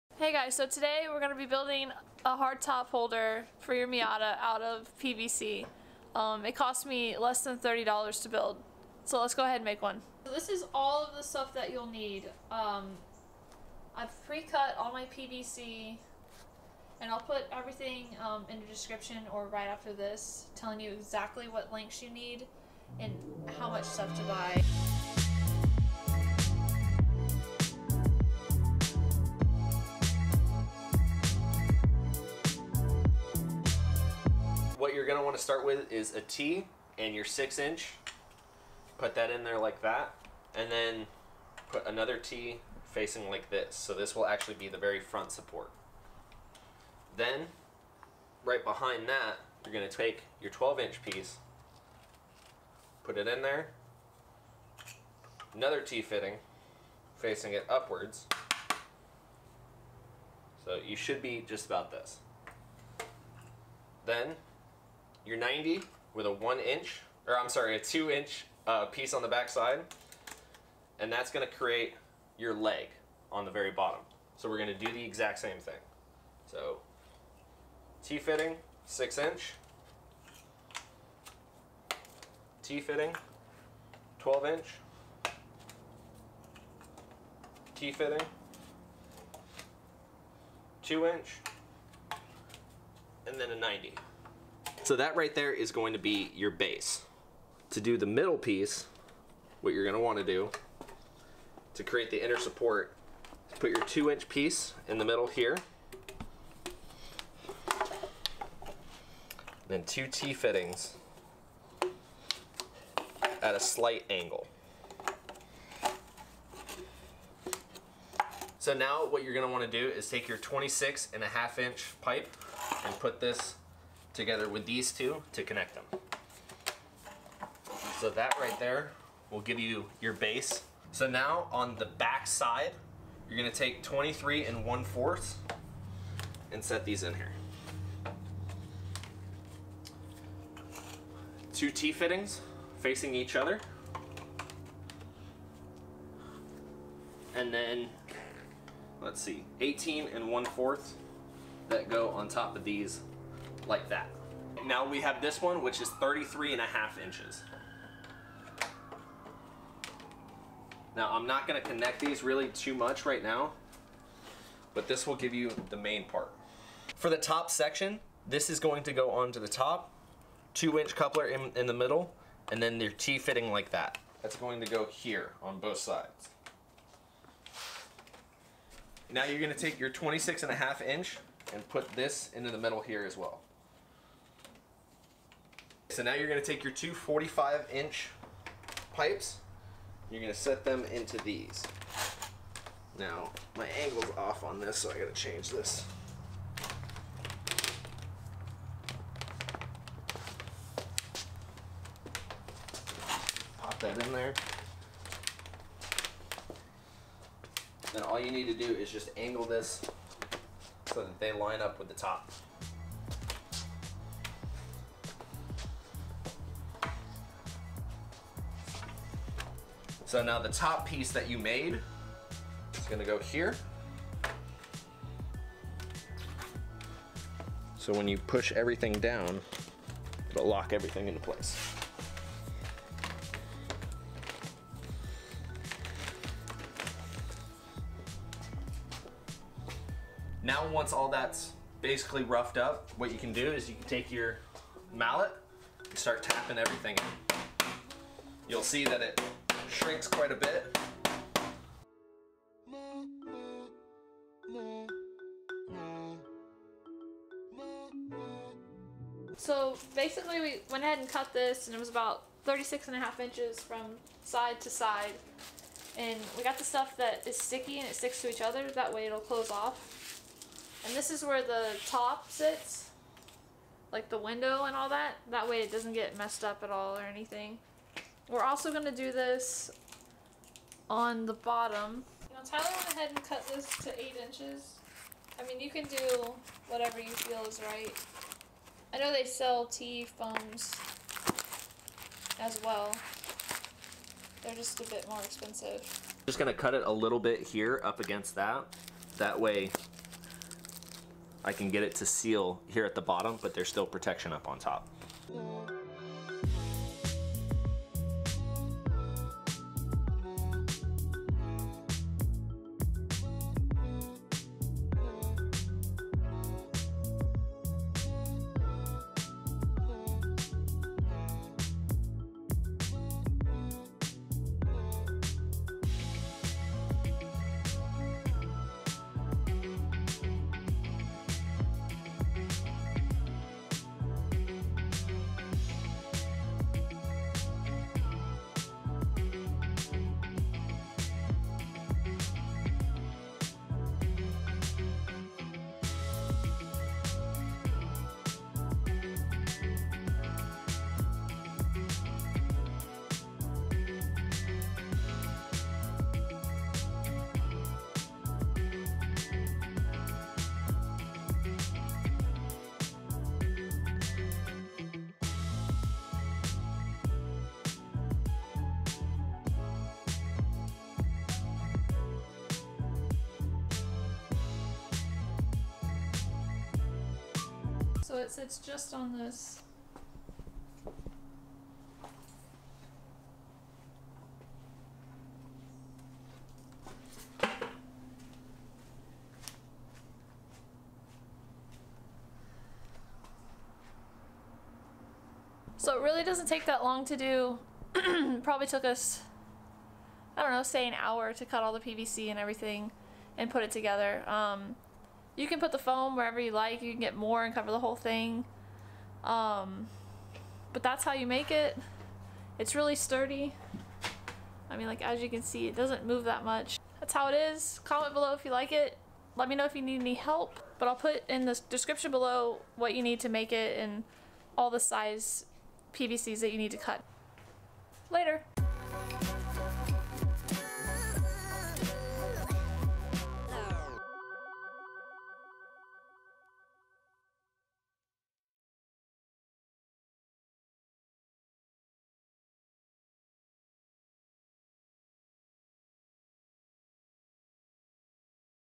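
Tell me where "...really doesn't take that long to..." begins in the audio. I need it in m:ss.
6:36.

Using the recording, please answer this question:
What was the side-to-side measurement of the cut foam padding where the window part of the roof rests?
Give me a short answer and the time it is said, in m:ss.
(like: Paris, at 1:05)
36 and a half inches, at 4:22.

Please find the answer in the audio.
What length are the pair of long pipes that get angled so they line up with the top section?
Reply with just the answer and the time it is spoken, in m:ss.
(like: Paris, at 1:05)
45 inch, at 3:06.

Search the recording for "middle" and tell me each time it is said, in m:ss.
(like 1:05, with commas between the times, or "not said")
1:38, 1:45, 2:51, 3:02.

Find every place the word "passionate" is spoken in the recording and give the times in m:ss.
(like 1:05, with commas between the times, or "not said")
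not said.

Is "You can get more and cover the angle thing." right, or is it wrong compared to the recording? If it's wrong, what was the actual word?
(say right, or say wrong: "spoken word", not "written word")
wrong: "whole", not "angle".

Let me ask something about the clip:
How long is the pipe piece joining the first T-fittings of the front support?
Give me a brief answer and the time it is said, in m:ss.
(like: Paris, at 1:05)
6 inch, at 0:37.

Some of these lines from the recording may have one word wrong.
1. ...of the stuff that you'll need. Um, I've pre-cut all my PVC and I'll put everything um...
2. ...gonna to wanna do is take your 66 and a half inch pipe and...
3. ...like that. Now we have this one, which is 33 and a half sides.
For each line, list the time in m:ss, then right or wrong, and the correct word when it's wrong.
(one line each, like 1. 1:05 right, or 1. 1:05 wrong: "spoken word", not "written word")
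1. 0:11 right
2. 1:59 wrong: "26", not "66"
3. 2:33 wrong: "inches", not "sides".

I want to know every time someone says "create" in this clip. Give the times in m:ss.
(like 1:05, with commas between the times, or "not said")
1:11, 1:41.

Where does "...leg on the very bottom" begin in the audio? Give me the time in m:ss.
1:12.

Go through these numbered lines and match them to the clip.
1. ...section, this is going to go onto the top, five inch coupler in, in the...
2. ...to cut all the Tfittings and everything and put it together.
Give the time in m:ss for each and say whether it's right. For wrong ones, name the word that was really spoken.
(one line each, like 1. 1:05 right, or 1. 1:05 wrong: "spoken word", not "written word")
1. 2:47 wrong: "two", not "five"
2. 6:41 wrong: "PVC", not "Tfittings".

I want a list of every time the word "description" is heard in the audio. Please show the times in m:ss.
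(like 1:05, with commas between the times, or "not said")
0:18, 7:01.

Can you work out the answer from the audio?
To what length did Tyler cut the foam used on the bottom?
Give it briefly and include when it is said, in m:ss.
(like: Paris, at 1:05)
8 inches, at 4:43.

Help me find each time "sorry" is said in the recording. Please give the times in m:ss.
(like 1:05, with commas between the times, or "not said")
1:07.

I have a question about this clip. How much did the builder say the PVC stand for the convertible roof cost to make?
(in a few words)
less than $30.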